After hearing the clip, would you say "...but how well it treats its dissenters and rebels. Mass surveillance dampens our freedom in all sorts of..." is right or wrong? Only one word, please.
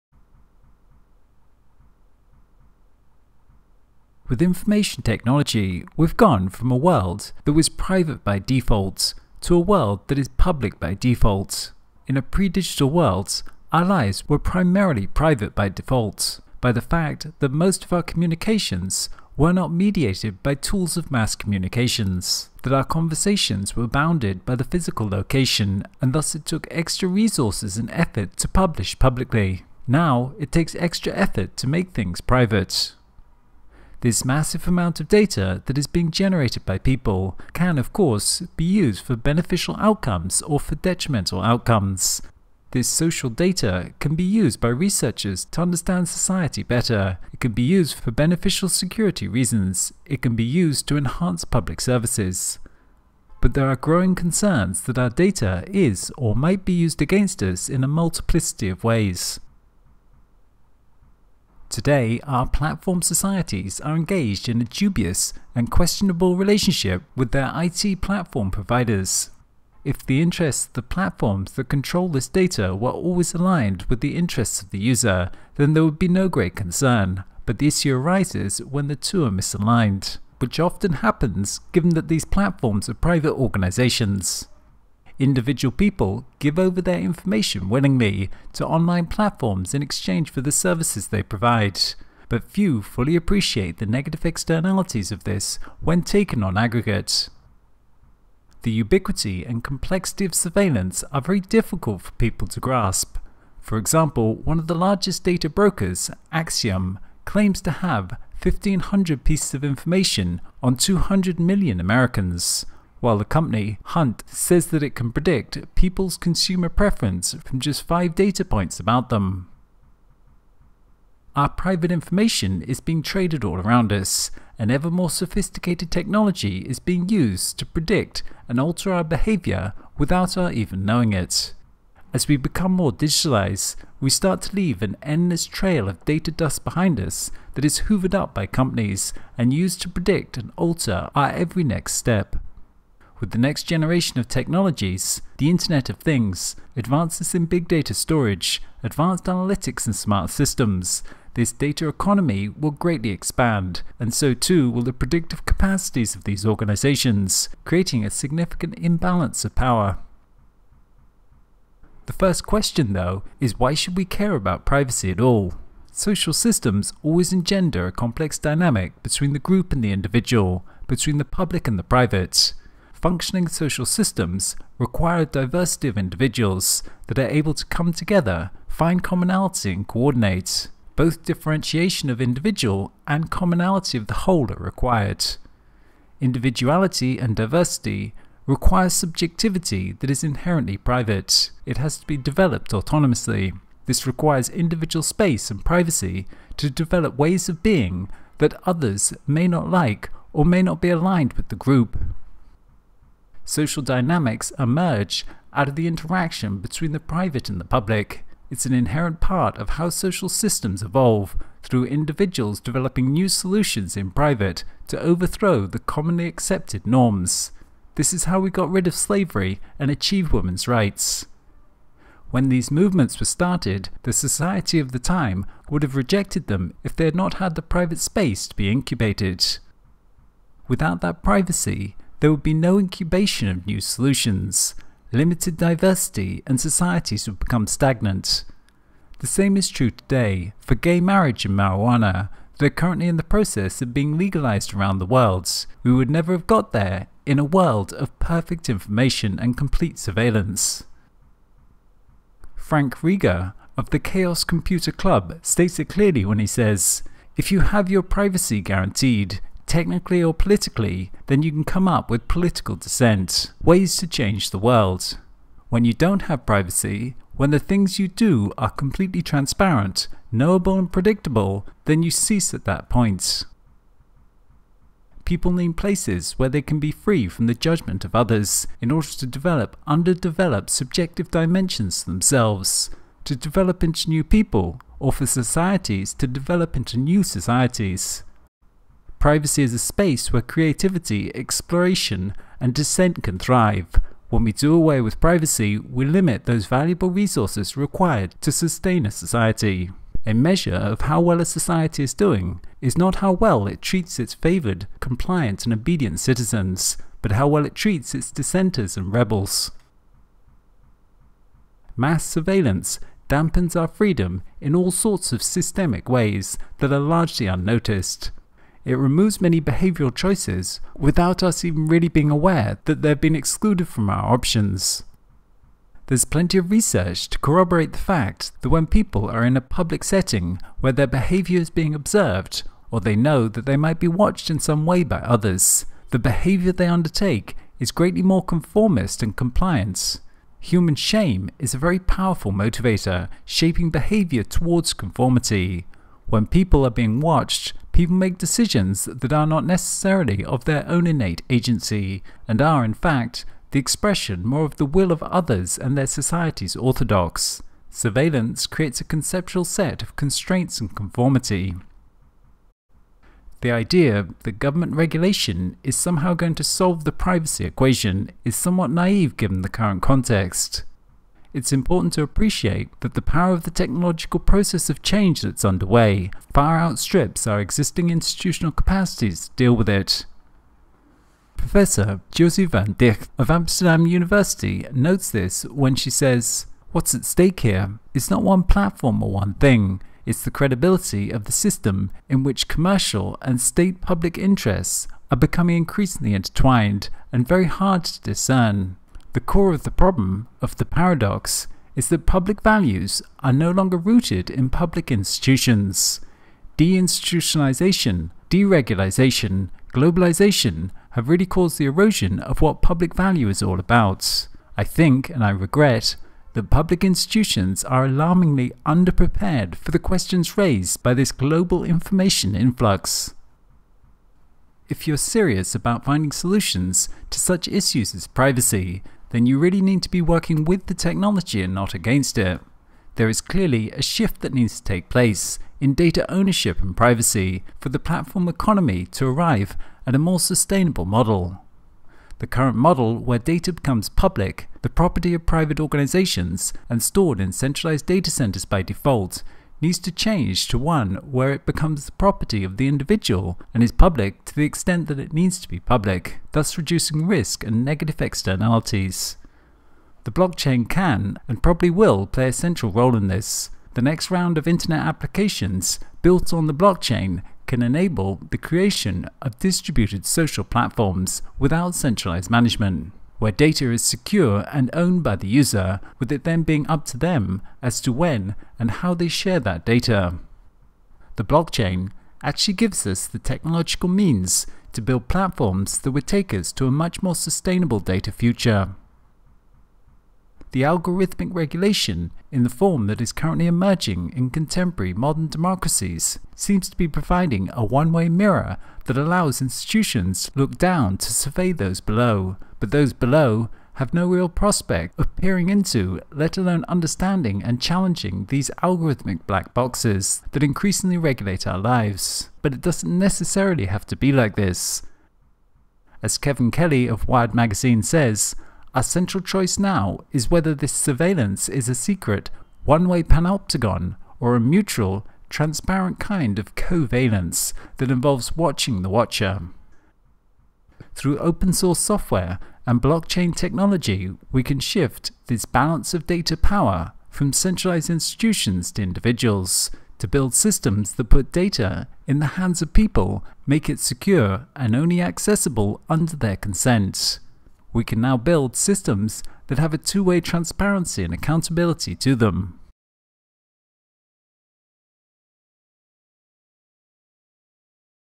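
right.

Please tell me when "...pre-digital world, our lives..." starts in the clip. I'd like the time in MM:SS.
00:12.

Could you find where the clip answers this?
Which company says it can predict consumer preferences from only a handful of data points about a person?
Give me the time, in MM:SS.
01:53.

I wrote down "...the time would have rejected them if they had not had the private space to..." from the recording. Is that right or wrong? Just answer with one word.
right.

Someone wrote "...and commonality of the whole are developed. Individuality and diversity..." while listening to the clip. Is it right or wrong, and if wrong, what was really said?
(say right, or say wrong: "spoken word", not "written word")
wrong: "required", not "developed".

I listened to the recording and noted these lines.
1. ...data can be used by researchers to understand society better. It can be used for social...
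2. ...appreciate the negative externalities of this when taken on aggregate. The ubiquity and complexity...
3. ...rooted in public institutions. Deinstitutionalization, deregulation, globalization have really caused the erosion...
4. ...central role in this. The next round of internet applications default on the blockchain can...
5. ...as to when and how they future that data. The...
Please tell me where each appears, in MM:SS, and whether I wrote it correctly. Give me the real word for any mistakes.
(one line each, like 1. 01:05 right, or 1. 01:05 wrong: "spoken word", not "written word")
1. 00:43 wrong: "beneficial", not "social"
2. 01:33 right
3. 06:43 right
4. 07:42 wrong: "built", not "default"
5. 07:57 wrong: "share", not "future".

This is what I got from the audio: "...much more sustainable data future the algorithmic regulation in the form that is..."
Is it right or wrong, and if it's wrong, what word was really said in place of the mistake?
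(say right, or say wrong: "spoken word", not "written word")
right.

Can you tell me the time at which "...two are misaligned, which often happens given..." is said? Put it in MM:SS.
01:18.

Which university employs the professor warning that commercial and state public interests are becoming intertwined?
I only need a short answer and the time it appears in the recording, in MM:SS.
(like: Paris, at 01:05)
Amsterdam University, at 06:23.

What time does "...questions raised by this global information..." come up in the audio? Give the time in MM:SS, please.
06:59.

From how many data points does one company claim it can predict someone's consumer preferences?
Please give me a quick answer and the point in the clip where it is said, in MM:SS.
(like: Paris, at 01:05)
5, at 01:57.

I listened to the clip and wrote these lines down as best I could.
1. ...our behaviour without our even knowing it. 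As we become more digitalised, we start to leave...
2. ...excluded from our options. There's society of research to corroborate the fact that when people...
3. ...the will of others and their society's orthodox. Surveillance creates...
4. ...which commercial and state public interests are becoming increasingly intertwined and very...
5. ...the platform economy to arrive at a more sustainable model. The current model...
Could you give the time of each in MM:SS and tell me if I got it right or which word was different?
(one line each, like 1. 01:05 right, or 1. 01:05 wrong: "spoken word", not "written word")
1. 02:08 right
2. 05:23 wrong: "plenty", not "society"
3. 05:54 right
4. 06:32 right
5. 07:17 right.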